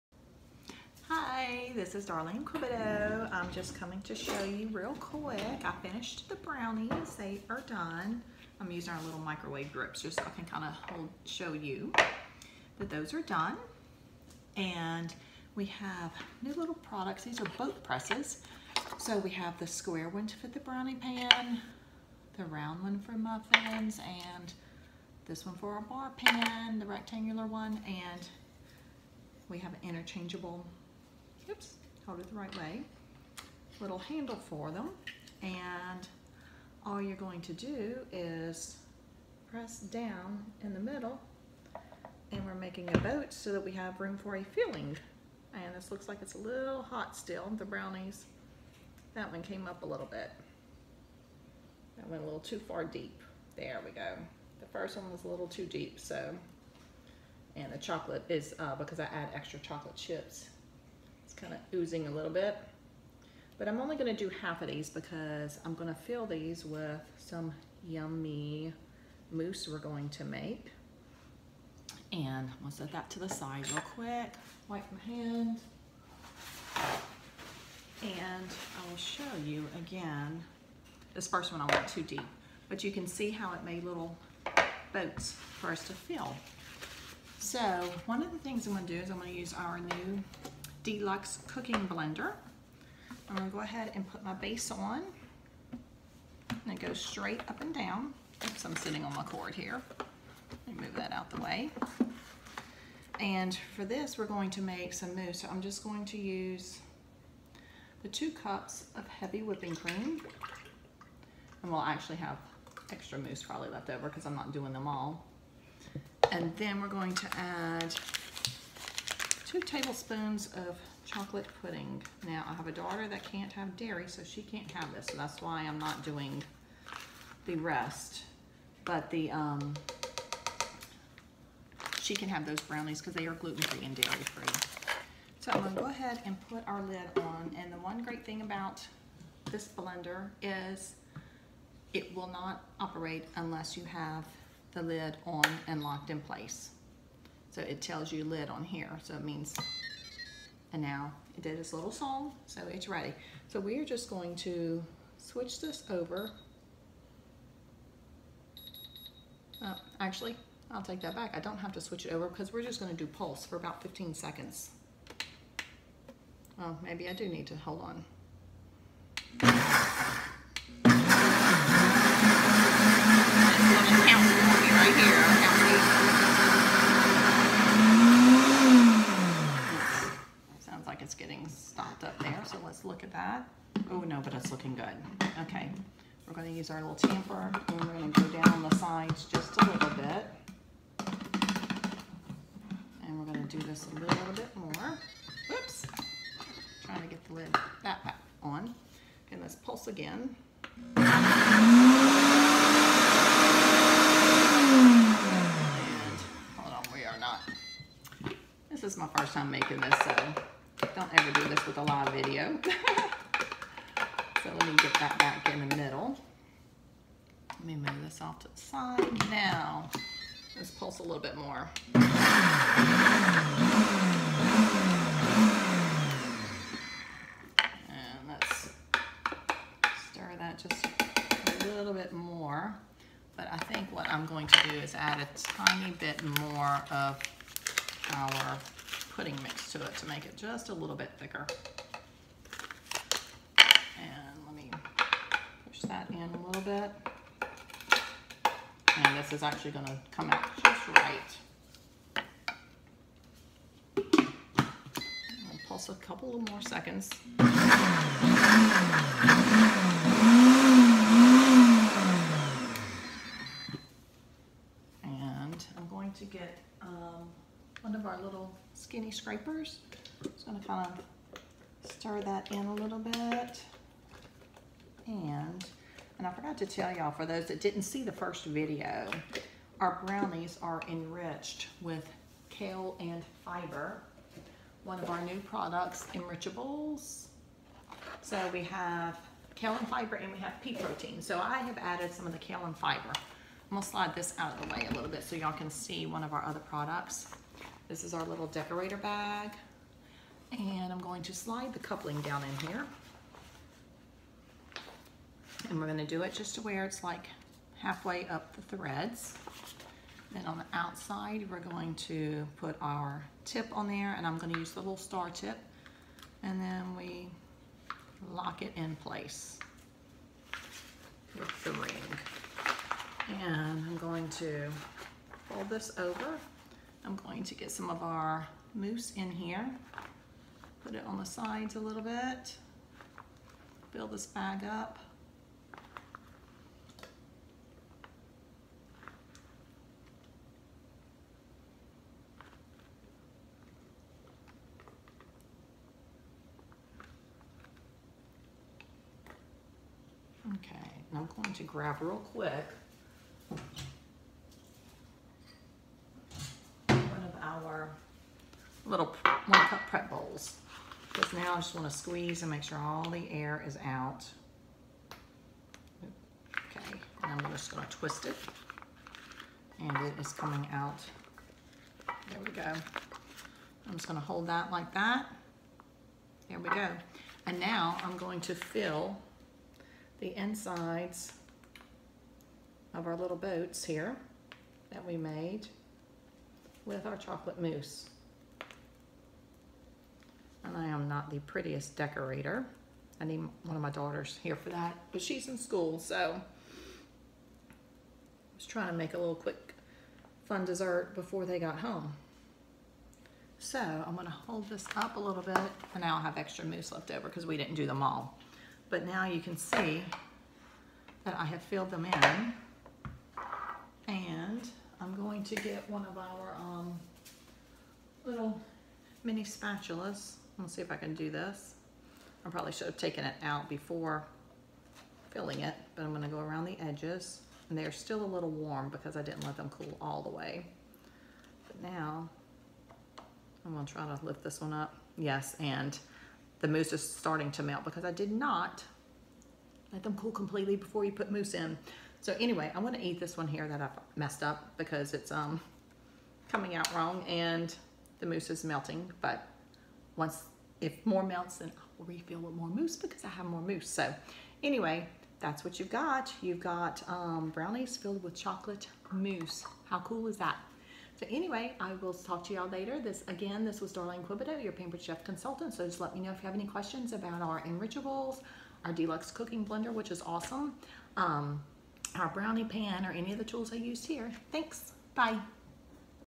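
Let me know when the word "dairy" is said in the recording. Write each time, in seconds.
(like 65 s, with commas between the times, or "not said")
123 s, 133 s.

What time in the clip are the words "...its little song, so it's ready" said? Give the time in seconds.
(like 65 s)
151 s.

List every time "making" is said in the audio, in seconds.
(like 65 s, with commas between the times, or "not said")
42 s, 209 s.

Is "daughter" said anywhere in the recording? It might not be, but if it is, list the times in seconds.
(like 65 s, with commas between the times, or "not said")
122 s, 393 s.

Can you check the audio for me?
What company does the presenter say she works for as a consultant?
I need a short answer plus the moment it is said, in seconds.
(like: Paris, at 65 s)
Pampered Chef, at 464 s.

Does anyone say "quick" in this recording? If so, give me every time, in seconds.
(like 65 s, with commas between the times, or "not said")
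5 s, 73 s, 352 s, 399 s.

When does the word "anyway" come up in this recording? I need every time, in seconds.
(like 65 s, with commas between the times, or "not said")
442 s, 454 s, 461 s.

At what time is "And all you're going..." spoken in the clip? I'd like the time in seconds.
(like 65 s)
35 s.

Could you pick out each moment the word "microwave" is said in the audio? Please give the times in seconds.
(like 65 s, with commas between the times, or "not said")
9 s.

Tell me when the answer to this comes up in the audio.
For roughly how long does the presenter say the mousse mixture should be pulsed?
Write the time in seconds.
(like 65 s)
163 s.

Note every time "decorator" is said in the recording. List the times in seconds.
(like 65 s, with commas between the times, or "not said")
298 s, 391 s.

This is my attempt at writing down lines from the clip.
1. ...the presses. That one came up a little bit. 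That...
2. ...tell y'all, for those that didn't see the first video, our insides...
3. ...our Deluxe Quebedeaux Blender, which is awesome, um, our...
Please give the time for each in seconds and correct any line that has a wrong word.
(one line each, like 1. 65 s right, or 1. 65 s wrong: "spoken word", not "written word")
1. 47 s wrong: "brownies", not "presses"
2. 276 s wrong: "brownies", not "insides"
3. 468 s wrong: "Cooking", not "Quebedeaux".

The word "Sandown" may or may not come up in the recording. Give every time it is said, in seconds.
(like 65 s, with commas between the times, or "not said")
not said.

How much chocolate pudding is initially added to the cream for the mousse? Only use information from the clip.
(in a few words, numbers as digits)
2 tablespoons.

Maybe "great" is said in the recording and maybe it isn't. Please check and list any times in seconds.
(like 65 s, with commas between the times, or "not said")
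138 s.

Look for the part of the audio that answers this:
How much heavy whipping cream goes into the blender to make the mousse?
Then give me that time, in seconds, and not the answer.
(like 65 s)
108 s.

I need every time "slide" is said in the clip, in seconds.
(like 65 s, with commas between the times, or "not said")
293 s, 301 s.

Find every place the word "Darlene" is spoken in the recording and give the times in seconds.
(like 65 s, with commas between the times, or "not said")
2 s, 463 s.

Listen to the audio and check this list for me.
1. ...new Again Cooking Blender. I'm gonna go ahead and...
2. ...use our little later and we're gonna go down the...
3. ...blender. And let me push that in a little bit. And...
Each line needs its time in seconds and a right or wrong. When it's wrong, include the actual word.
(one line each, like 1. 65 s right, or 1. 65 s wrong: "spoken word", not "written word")
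1. 89 s wrong: "Deluxe", not "Again"
2. 186 s wrong: "tamper", not "later"
3. 241 s wrong: "thicker", not "blender".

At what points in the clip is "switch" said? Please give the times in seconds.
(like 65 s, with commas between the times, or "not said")
155 s, 161 s.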